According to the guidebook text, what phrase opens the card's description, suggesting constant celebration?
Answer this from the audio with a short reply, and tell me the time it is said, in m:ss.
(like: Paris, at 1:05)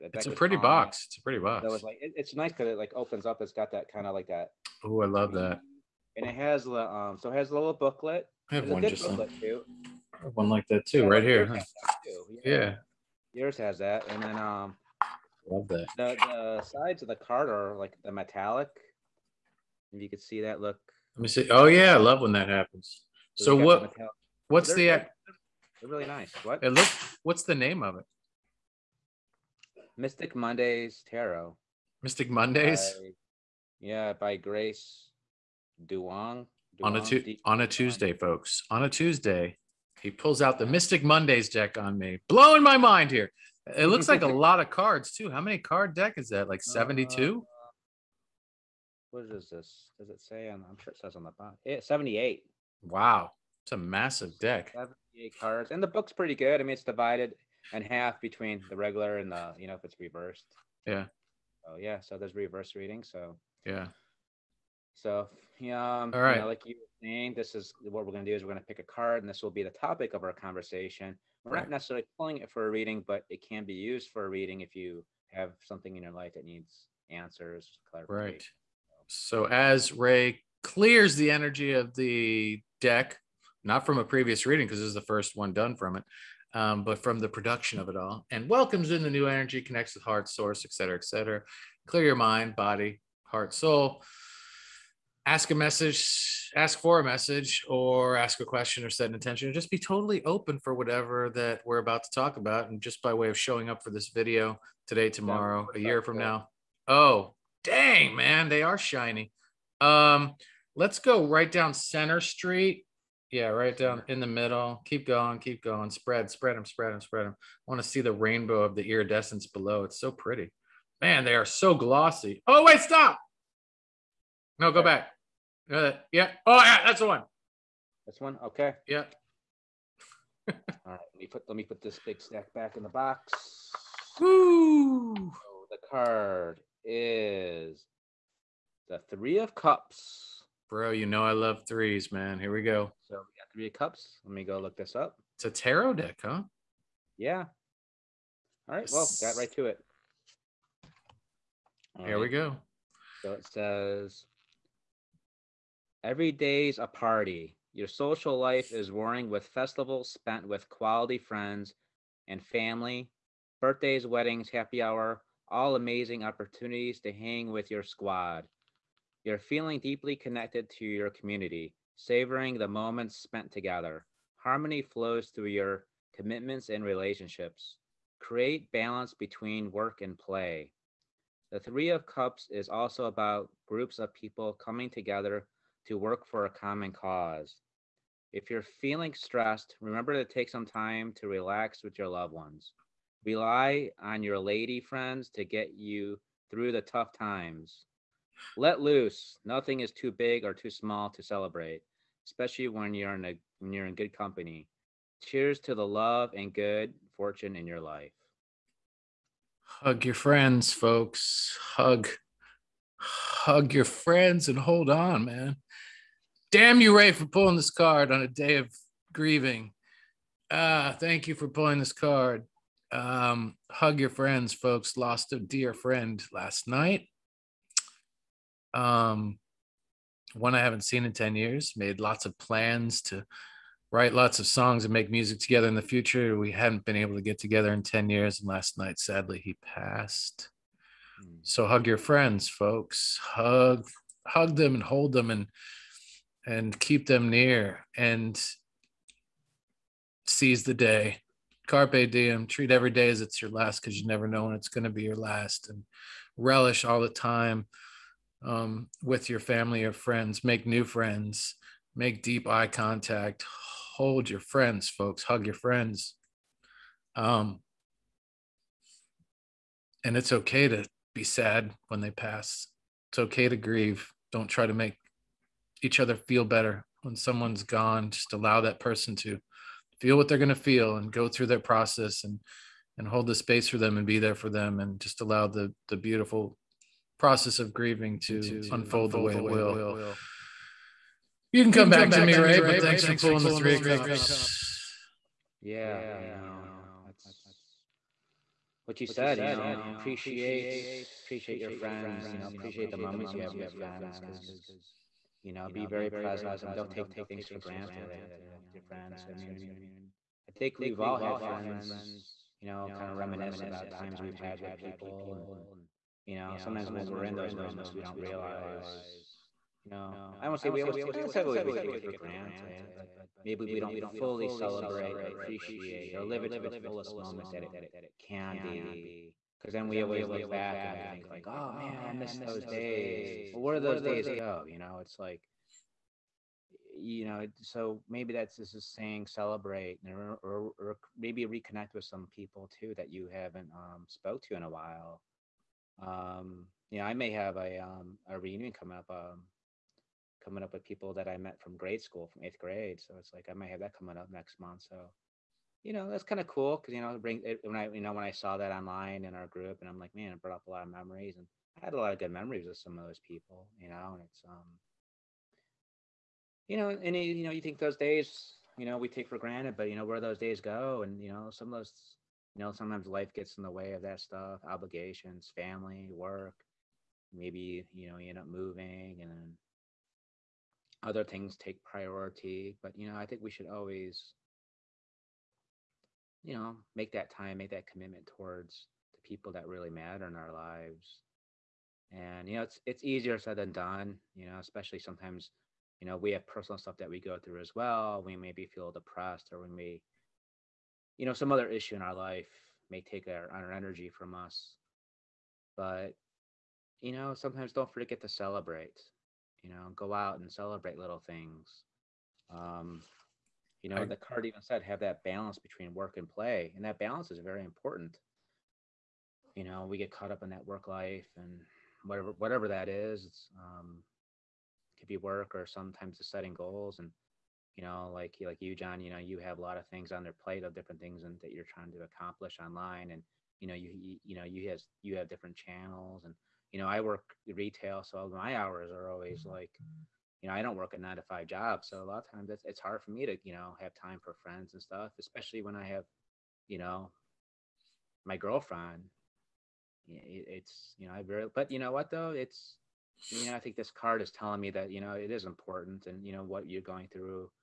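Every day's a party, at 2:36.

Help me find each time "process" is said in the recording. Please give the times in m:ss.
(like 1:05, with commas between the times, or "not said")
4:41, 4:47.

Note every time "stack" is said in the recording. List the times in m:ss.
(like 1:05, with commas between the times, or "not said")
2:12.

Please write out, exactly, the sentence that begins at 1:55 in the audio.
Spread, spread them, spread them, spread them.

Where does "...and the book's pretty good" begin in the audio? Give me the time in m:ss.
0:55.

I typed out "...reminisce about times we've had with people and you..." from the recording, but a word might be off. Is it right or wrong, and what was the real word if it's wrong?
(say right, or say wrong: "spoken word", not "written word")
right.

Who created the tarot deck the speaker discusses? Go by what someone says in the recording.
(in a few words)
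Grace Duong.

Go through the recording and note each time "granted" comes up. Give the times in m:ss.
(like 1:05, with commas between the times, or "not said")
5:07, 5:22, 6:09.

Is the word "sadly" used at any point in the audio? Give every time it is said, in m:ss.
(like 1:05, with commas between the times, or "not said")
3:58.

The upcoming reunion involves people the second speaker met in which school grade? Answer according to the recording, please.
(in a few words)
Eighth grade.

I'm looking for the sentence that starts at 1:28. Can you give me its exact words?
And welcomes in the new energy, connects with heart, source, et cetera, et cetera.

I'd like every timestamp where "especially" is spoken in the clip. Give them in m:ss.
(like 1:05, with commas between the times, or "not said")
3:22, 6:34, 7:25.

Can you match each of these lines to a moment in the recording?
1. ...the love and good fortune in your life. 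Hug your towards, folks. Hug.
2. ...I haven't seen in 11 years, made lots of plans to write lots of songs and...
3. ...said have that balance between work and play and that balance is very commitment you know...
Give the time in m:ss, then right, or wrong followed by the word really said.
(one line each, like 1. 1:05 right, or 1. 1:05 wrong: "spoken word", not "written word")
1. 3:25 wrong: "friends", not "towards"
2. 3:50 wrong: "10", not "11"
3. 6:54 wrong: "important", not "commitment".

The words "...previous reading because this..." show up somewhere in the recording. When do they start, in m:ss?
1:24.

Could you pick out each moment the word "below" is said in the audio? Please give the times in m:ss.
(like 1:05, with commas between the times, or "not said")
1:59.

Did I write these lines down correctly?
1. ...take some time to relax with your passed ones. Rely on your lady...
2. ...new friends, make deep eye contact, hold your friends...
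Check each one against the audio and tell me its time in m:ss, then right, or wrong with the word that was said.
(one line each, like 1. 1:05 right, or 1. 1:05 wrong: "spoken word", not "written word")
1. 3:10 wrong: "loved", not "passed"
2. 4:20 right.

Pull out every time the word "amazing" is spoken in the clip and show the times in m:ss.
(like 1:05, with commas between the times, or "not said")
2:45.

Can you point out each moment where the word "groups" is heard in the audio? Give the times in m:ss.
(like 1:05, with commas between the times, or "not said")
3:03, 5:59.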